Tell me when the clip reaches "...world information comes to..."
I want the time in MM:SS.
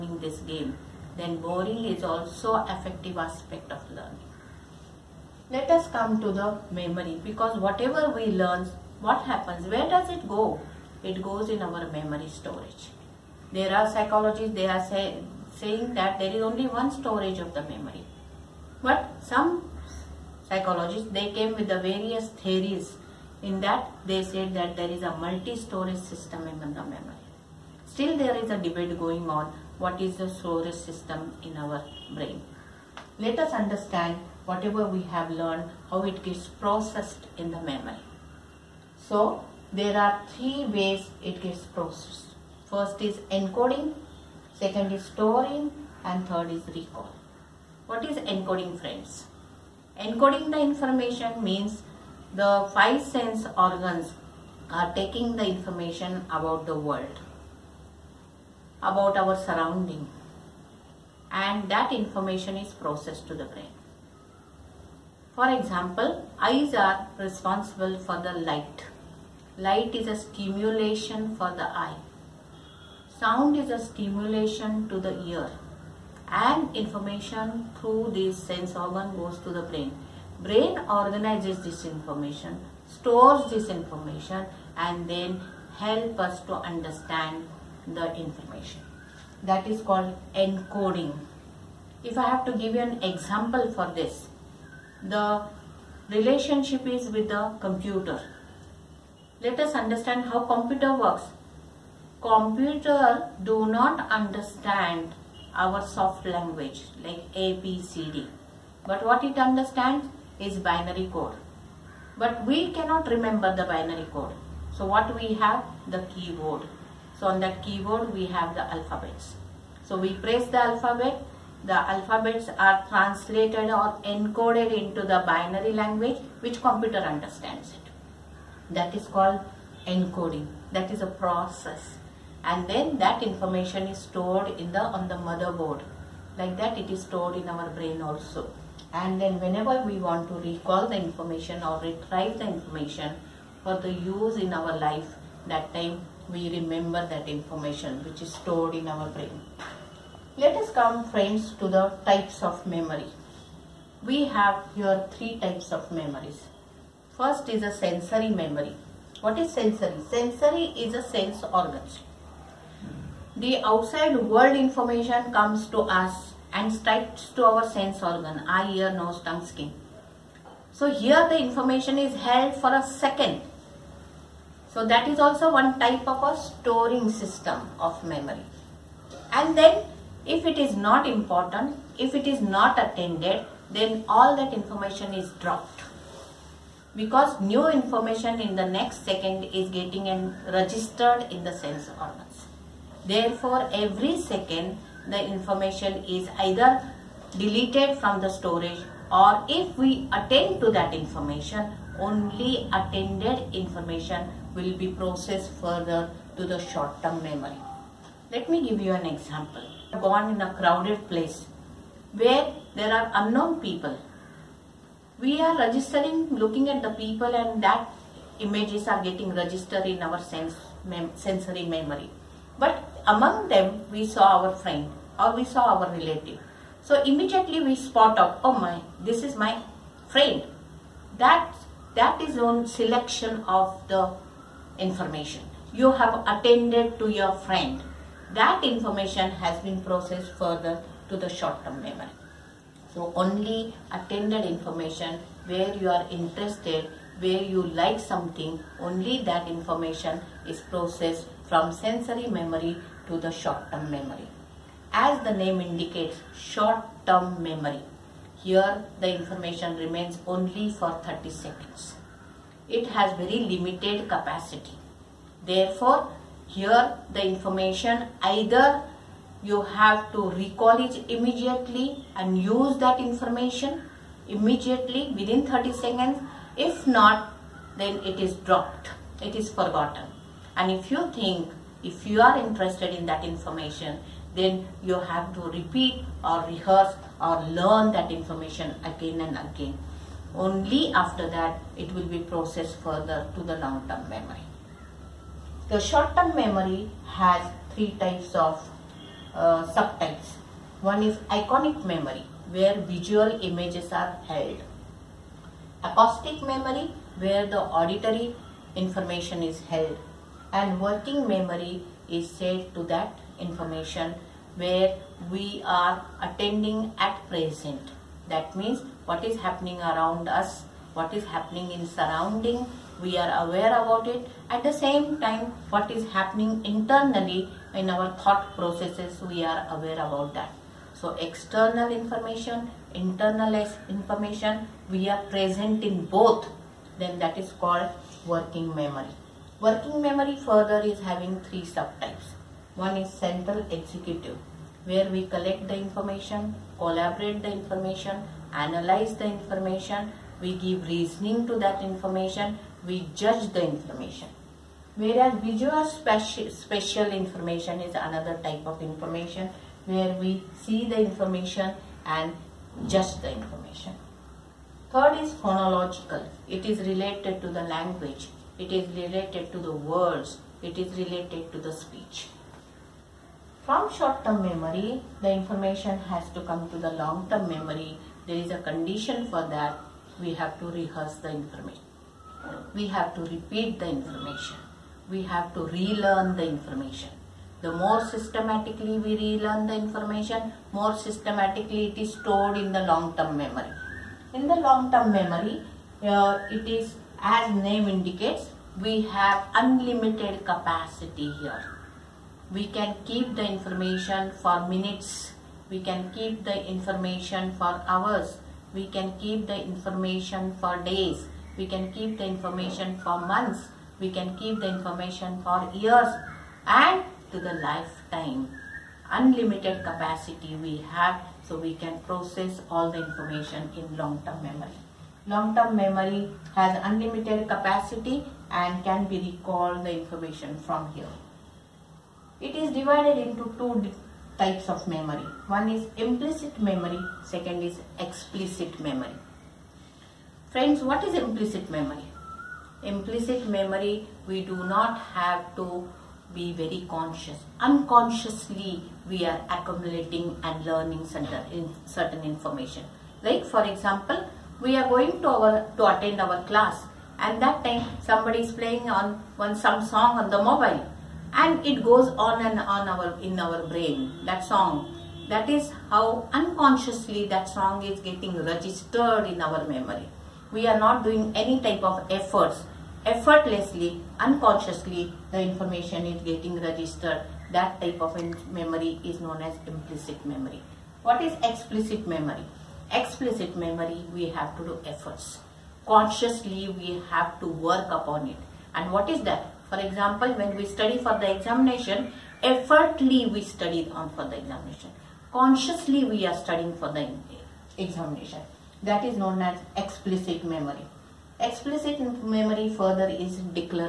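02:44.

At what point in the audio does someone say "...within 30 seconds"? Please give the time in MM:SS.
04:35.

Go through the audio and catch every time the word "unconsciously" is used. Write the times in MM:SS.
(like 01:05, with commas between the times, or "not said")
07:27, 07:46, 07:54.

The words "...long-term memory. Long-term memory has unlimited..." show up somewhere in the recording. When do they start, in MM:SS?
07:03.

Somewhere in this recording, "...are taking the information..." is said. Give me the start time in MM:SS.
00:54.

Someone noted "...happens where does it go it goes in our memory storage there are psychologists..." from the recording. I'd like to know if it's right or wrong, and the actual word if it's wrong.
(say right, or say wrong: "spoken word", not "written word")
right.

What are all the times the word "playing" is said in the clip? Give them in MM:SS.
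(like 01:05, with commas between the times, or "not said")
07:38.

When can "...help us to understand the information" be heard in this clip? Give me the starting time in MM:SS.
01:25.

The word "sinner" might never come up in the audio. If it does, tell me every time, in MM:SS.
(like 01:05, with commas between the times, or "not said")
not said.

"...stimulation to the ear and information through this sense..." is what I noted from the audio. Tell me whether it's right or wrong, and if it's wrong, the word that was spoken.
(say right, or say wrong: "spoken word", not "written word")
right.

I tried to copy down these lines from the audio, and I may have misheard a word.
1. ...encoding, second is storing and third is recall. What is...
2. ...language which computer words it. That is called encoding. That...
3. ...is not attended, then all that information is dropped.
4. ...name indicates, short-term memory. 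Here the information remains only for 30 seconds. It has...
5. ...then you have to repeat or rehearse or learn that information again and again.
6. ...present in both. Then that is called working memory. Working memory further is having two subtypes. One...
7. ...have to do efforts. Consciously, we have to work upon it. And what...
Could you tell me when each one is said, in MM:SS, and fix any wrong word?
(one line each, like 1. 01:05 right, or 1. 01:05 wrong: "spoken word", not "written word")
1. 00:43 right
2. 02:05 wrong: "understands", not "words"
3. 03:02 right
4. 04:15 right
5. 04:44 right
6. 05:35 wrong: "three", not "two"
7. 08:04 right.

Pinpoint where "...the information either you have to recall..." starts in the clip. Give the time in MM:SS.
04:27.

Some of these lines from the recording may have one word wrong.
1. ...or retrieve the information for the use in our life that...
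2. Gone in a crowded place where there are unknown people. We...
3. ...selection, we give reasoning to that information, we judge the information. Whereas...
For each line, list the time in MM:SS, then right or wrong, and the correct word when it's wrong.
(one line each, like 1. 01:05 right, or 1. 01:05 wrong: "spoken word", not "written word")
1. 02:21 right
2. 03:29 right
3. 05:49 wrong: "information", not "selection".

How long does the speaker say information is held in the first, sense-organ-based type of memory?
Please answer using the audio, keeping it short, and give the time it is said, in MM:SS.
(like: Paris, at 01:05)
A second, at 02:52.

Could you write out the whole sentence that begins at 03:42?
But among them we saw our friend or we saw our relative.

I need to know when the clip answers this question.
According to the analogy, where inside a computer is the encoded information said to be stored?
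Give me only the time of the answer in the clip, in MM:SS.
02:15.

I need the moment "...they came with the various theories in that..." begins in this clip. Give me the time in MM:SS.
00:21.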